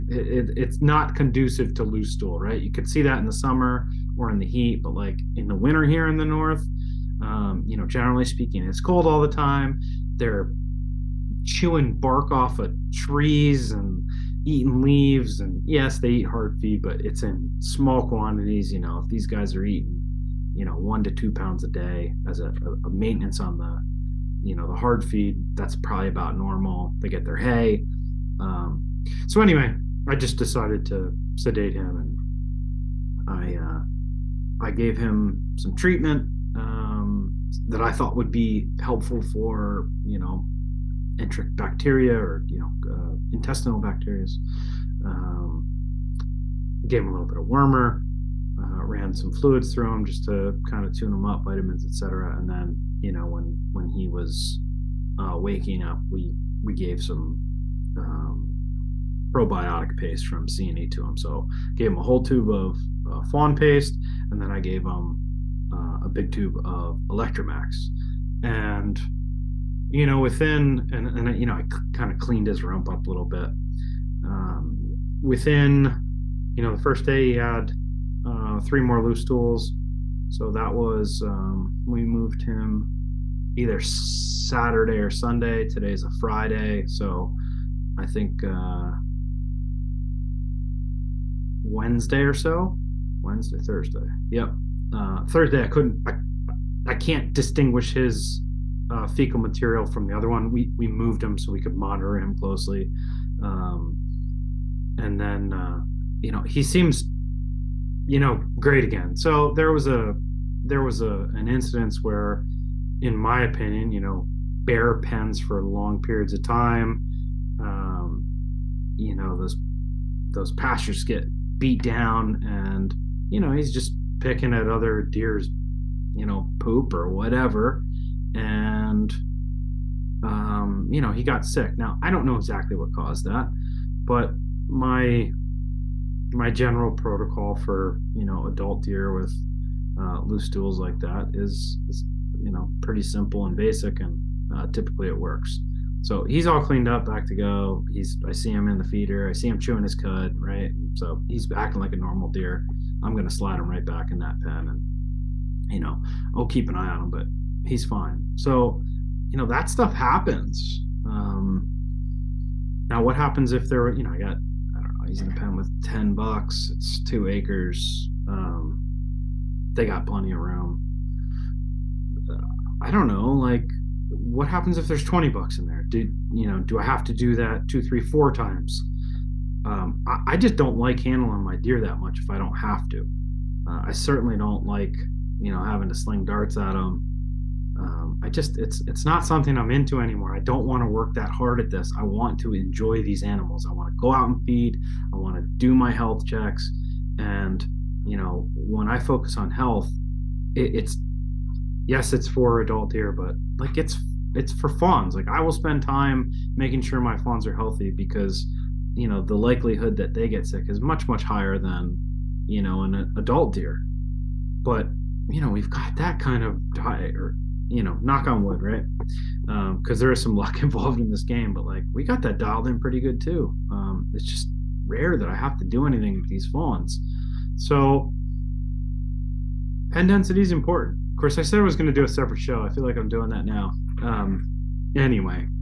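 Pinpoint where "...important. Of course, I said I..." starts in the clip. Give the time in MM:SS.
03:50.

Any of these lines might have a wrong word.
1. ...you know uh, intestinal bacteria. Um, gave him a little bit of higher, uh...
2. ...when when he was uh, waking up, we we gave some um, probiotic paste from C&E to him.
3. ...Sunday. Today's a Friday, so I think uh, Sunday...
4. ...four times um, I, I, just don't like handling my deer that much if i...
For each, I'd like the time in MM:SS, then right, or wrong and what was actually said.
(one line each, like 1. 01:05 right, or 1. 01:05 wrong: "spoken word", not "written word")
1. 00:42 wrong: "warmer", not "higher"
2. 00:53 right
3. 01:25 wrong: "Wednesday", not "Sunday"
4. 02:57 right.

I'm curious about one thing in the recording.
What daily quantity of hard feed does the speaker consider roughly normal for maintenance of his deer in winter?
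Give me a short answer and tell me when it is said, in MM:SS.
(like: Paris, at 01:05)
1 to 2 pounds, at 00:20.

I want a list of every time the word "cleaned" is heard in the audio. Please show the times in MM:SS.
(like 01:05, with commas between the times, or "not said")
01:12, 02:26.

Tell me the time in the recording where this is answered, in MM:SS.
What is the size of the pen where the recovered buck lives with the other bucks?
02:47.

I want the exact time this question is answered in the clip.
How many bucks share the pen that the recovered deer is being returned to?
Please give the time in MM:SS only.
02:45.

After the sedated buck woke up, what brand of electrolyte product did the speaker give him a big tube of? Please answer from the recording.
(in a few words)
Electromax.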